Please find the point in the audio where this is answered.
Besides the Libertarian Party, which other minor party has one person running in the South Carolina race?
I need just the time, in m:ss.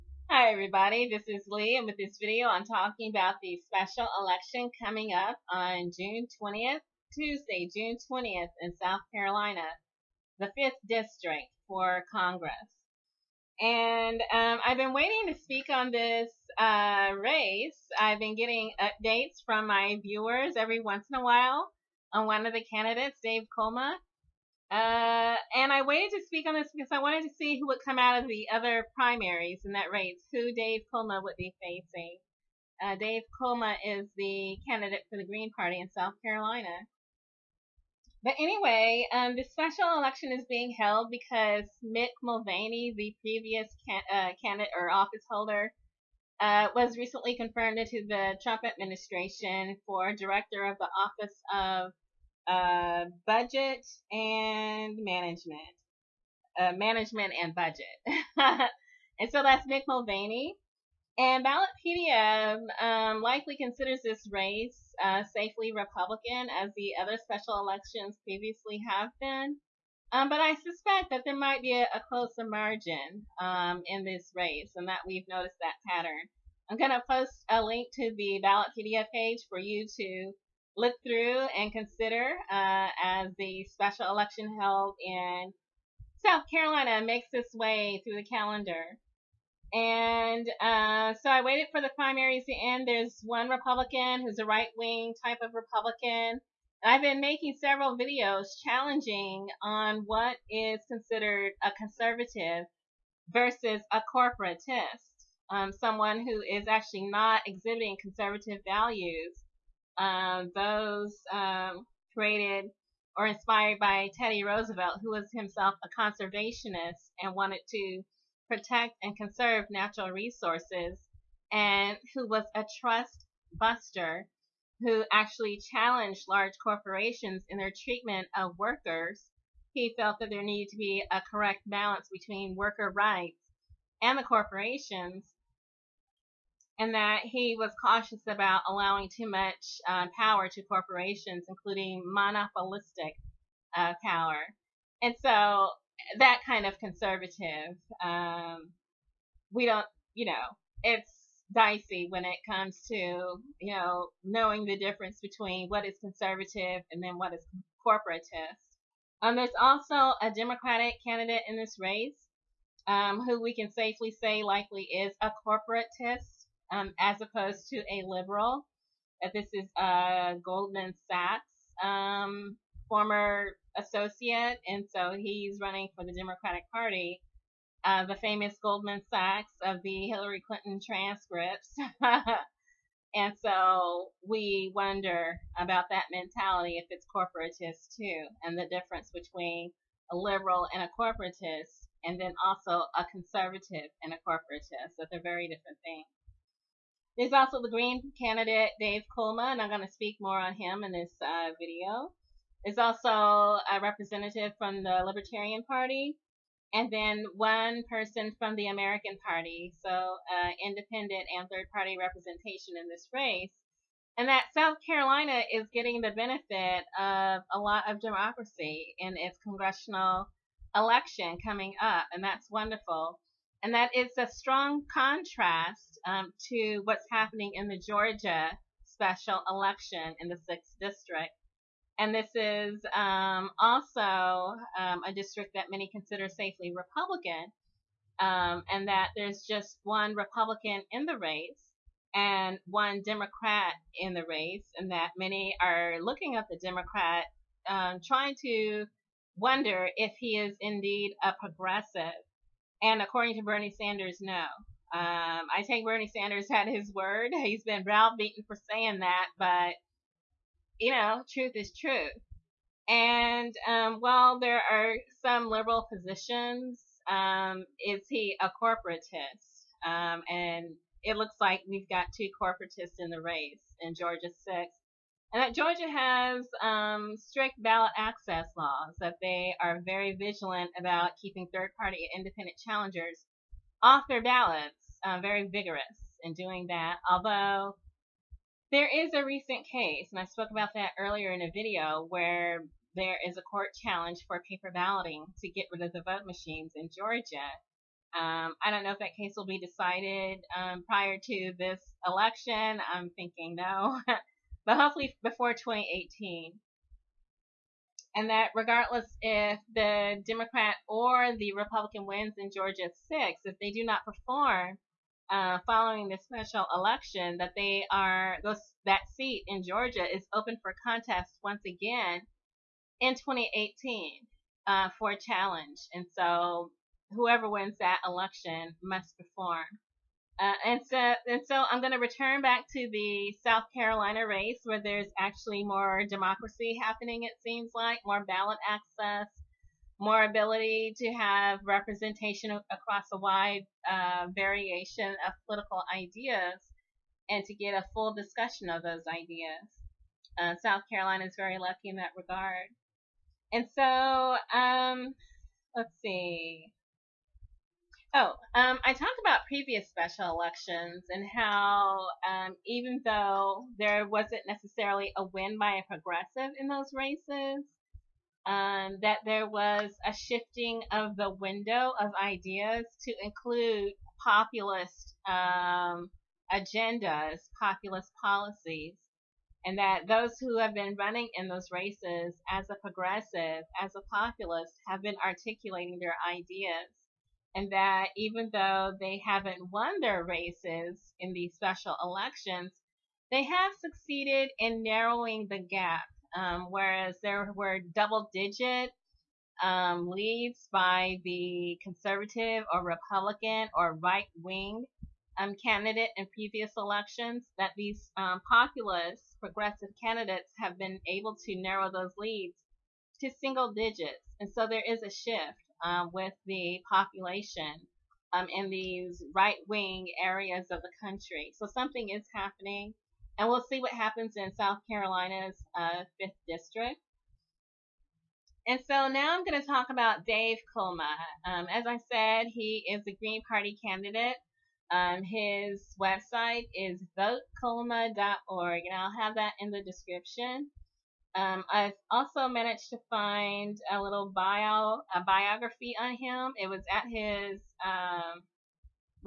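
3:28.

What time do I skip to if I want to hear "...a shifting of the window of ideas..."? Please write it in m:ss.
6:10.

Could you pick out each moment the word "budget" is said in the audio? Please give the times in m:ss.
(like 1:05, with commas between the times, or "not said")
0:53, 0:57.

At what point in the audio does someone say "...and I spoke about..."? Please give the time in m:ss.
4:50.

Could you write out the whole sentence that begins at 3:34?
And that South Carolina is getting the benefit of a lot of democracy in its congressional election coming up, and that's wonderful.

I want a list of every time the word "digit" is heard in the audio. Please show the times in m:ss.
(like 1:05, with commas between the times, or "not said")
6:38, 6:53.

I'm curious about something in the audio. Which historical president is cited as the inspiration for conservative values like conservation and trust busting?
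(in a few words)
Teddy Roosevelt.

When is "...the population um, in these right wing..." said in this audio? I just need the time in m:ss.
6:56.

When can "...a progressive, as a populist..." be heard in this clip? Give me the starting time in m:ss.
6:22.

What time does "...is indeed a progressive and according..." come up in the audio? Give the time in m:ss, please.
4:10.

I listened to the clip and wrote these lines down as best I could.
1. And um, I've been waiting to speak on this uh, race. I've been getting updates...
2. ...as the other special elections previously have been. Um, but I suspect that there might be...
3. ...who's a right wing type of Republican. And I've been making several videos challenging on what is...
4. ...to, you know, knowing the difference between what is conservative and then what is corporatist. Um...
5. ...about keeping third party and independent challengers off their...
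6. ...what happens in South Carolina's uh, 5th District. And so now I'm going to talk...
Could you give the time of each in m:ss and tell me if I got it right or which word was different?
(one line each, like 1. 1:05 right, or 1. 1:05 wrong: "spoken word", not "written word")
1. 0:13 right
2. 1:06 right
3. 1:34 right
4. 2:32 right
5. 4:40 right
6. 7:03 right.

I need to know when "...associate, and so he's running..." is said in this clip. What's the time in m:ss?
2:53.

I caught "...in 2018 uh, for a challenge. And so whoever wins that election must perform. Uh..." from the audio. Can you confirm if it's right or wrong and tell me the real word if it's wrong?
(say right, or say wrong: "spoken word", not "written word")
right.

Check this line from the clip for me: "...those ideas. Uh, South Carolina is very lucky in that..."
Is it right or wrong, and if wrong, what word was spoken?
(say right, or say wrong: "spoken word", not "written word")
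right.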